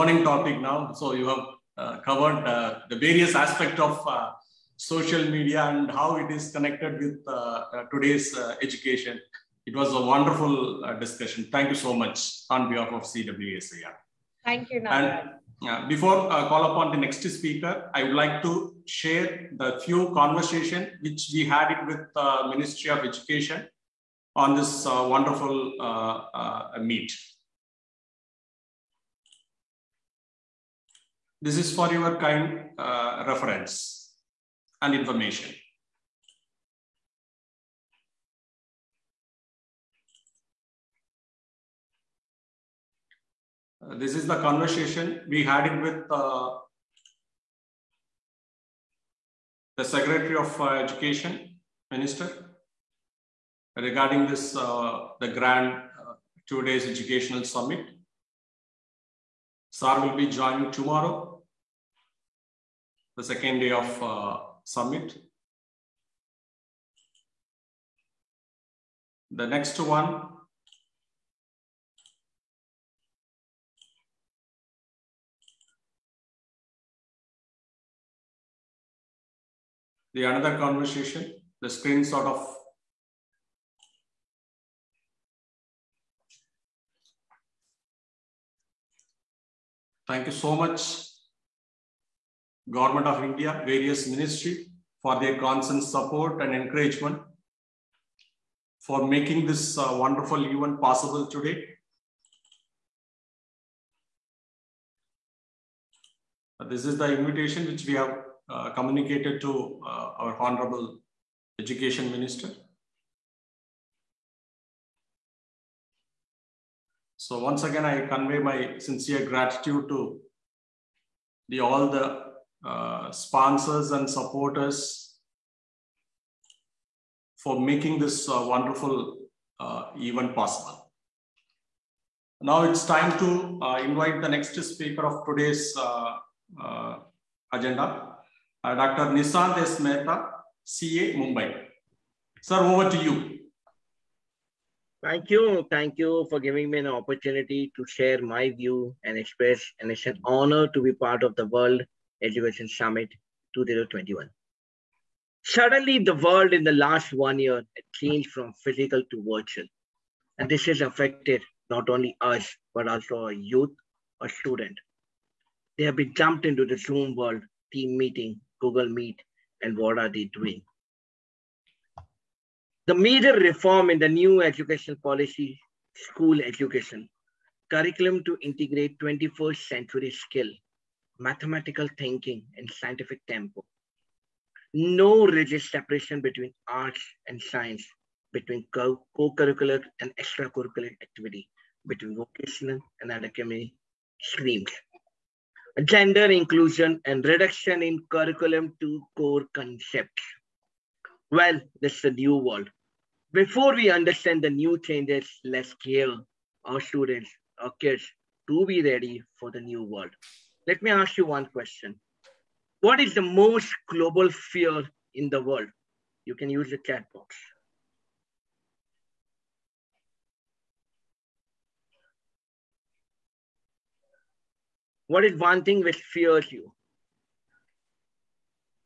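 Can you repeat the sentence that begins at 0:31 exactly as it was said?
This is for your kind uh, reference and information.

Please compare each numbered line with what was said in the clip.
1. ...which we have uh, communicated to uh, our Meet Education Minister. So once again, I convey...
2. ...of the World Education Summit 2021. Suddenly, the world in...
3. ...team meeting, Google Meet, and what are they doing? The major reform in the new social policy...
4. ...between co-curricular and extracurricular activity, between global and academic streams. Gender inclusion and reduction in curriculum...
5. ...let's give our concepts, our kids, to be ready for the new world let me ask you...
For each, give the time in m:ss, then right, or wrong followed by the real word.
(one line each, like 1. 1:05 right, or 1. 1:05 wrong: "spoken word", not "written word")
1. 1:47 wrong: "Honorable", not "Meet"
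2. 2:31 right
3. 2:47 wrong: "educational", not "social"
4. 3:08 wrong: "vocational", not "global"
5. 3:25 wrong: "students", not "concepts".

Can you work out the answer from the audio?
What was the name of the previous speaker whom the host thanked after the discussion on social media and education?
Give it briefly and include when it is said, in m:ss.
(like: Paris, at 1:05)
Nagaraj, at 0:14.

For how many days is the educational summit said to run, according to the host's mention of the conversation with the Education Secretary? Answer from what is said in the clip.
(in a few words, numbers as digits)
2.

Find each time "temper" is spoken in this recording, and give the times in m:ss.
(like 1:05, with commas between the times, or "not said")
3:03.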